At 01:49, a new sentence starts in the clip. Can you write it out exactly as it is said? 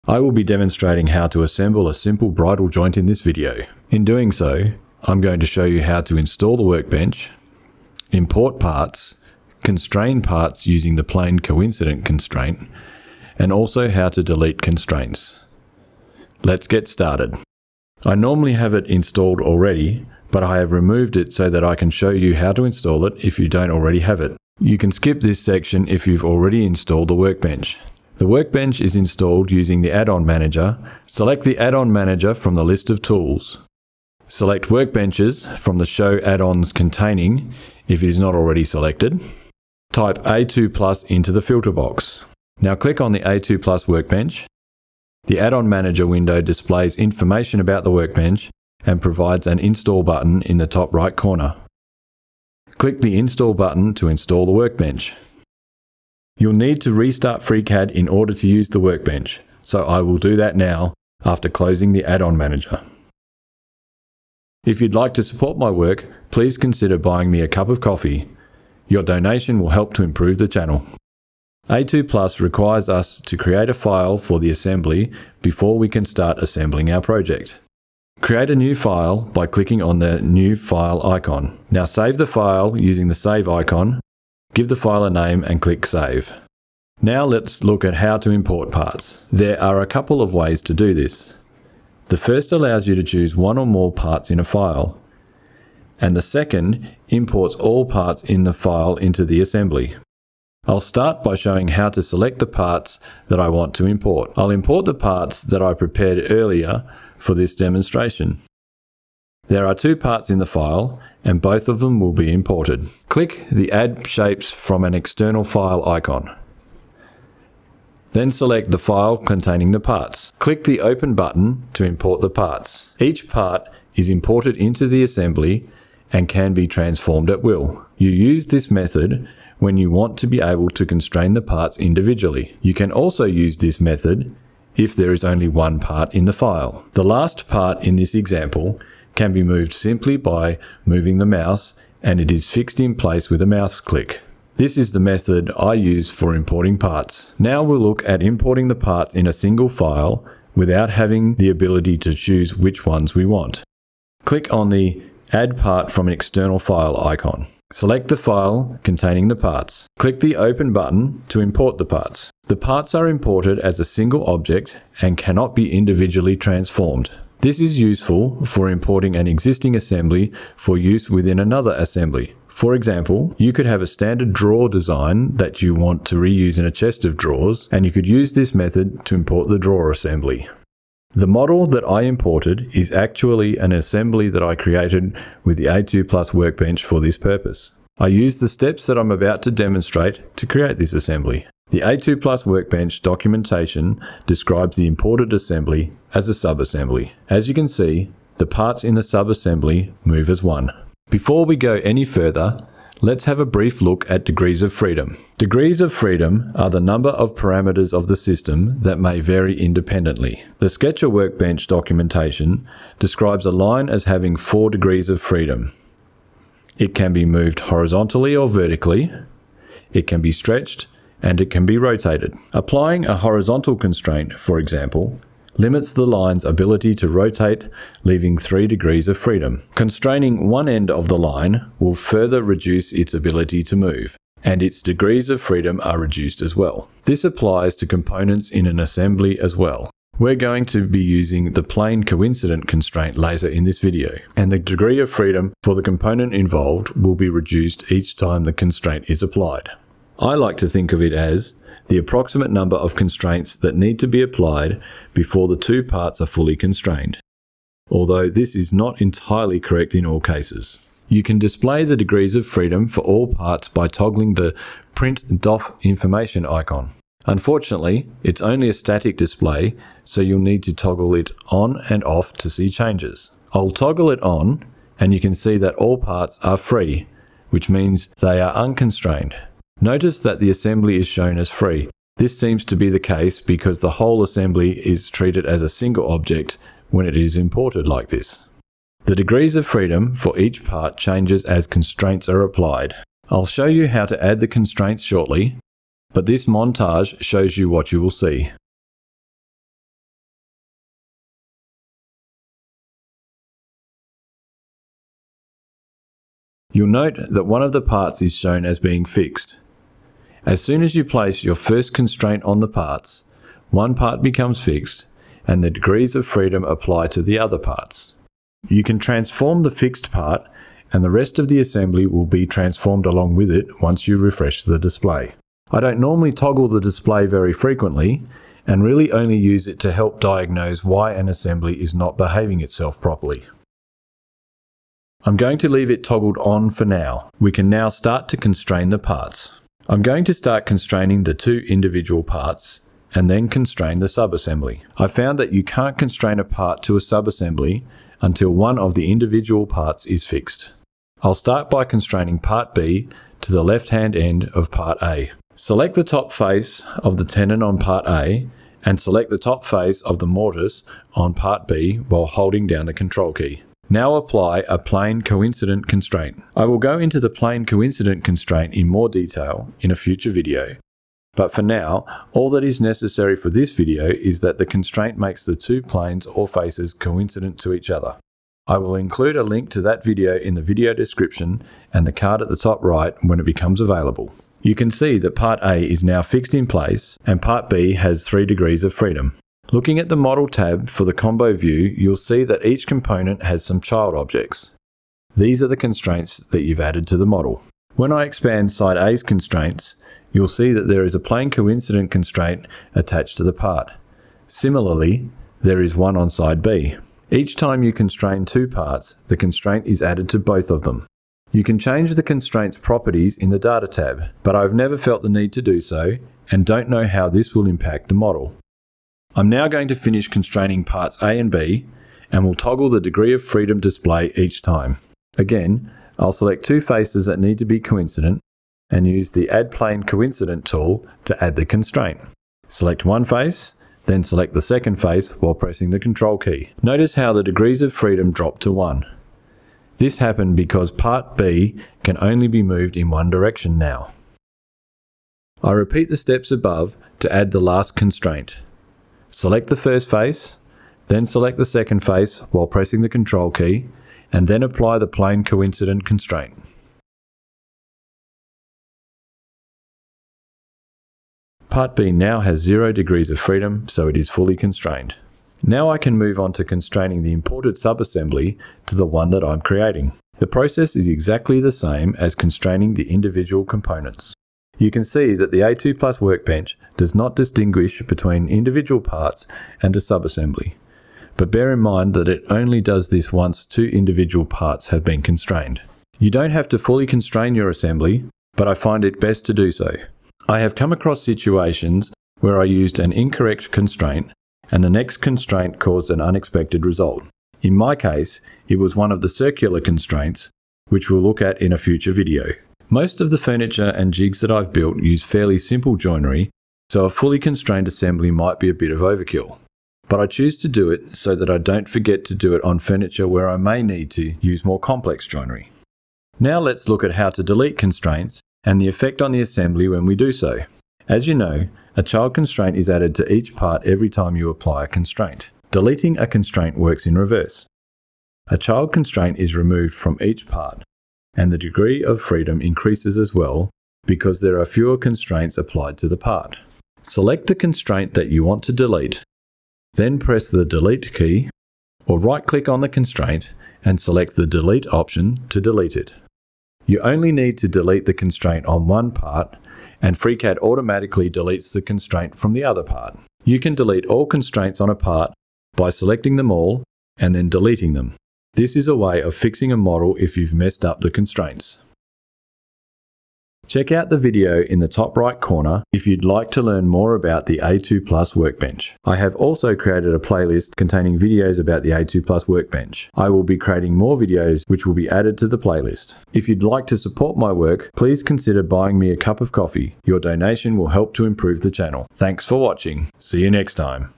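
There are two parts in the file and both of them will be imported.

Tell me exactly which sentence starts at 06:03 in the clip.
Now apply a plane coincident constraint.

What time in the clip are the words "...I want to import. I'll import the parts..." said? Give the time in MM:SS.
01:43.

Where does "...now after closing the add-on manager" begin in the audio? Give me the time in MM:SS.
01:00.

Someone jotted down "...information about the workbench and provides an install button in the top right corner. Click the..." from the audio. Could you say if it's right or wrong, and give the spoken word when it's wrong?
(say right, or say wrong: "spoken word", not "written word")
right.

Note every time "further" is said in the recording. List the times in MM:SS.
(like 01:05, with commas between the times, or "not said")
03:22, 03:51.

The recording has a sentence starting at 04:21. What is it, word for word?
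You can display the degrees of freedom for all parts by toggling the print DOF information icon.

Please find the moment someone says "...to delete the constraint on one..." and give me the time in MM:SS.
09:07.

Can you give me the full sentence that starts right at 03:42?
Applying a horizontal constraint, for example, limits the line's ability to rotate, leaving 3 degrees of freedom.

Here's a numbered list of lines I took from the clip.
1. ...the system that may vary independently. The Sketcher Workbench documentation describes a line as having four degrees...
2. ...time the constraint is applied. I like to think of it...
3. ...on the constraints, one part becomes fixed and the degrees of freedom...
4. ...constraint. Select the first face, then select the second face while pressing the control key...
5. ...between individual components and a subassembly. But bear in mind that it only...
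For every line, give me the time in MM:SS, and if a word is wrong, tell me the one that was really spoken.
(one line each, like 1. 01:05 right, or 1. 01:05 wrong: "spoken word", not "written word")
1. 03:28 right
2. 04:08 right
3. 05:12 wrong: "parts", not "constraints"
4. 07:27 right
5. 07:58 wrong: "parts", not "components".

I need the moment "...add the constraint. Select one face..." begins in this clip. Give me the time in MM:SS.
07:11.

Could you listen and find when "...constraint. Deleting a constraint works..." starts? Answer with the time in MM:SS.
08:44.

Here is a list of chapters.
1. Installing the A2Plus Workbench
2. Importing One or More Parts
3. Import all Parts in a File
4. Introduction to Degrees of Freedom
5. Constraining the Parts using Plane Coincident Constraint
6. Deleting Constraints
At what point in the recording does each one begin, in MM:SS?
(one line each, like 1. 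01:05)
1. 00:17
2. 01:26
3. 02:27
4. 03:21
5. 05:37
6. 08:36.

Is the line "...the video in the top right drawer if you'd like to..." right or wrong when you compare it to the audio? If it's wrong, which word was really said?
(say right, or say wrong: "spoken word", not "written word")
wrong: "corner", not "drawer".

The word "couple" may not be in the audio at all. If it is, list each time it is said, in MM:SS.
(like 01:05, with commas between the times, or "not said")
01:29.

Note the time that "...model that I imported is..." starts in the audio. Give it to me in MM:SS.
03:01.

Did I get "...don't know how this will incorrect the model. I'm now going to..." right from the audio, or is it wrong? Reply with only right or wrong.
wrong.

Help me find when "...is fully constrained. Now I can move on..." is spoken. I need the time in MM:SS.
07:44.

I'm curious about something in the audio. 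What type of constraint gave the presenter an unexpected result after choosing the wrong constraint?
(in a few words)
circular constraints.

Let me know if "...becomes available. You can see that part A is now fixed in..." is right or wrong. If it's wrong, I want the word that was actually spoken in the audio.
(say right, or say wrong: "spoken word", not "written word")
right.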